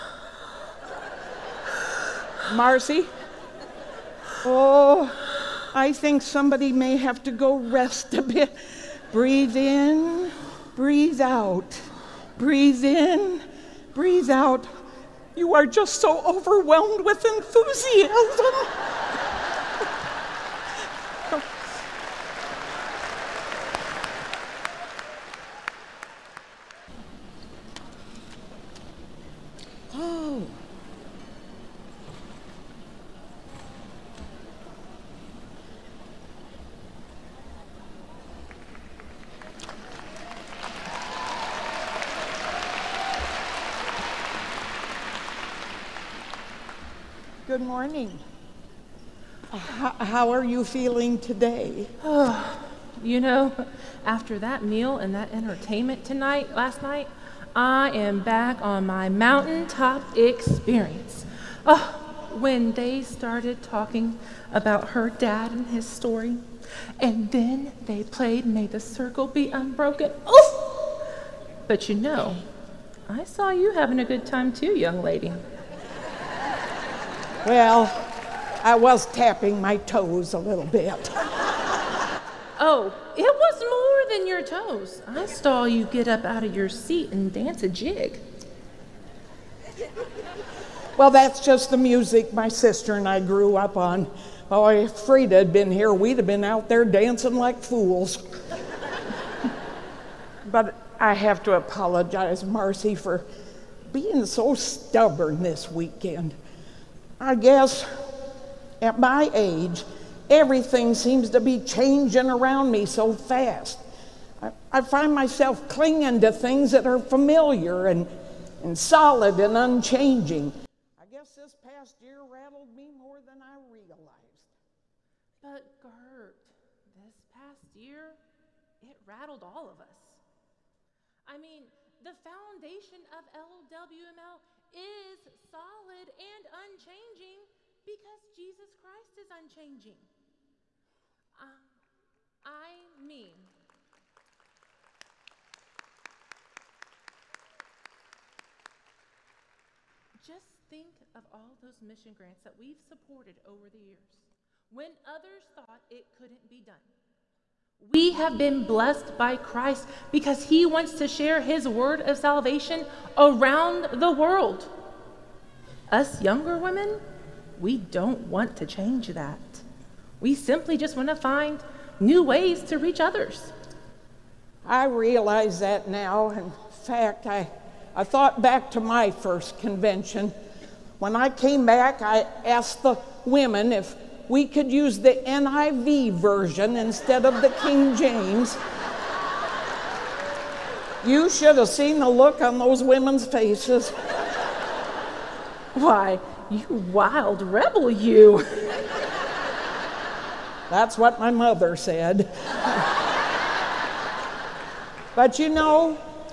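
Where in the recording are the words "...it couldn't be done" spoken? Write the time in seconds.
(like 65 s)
155 s.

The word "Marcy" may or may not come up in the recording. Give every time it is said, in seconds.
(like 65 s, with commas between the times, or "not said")
2 s, 102 s.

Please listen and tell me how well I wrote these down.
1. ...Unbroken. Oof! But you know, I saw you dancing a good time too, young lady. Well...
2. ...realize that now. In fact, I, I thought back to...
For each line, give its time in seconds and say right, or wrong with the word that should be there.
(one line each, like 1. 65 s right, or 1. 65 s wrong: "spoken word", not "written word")
1. 69 s wrong: "having", not "dancing"
2. 174 s right.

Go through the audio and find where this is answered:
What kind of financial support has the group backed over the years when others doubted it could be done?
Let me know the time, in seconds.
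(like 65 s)
151 s.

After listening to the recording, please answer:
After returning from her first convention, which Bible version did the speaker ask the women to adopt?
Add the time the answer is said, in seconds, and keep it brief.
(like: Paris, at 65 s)
NIV, at 185 s.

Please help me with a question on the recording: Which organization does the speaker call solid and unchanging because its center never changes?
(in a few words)
LWML.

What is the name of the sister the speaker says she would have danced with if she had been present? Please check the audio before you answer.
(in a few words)
Frida.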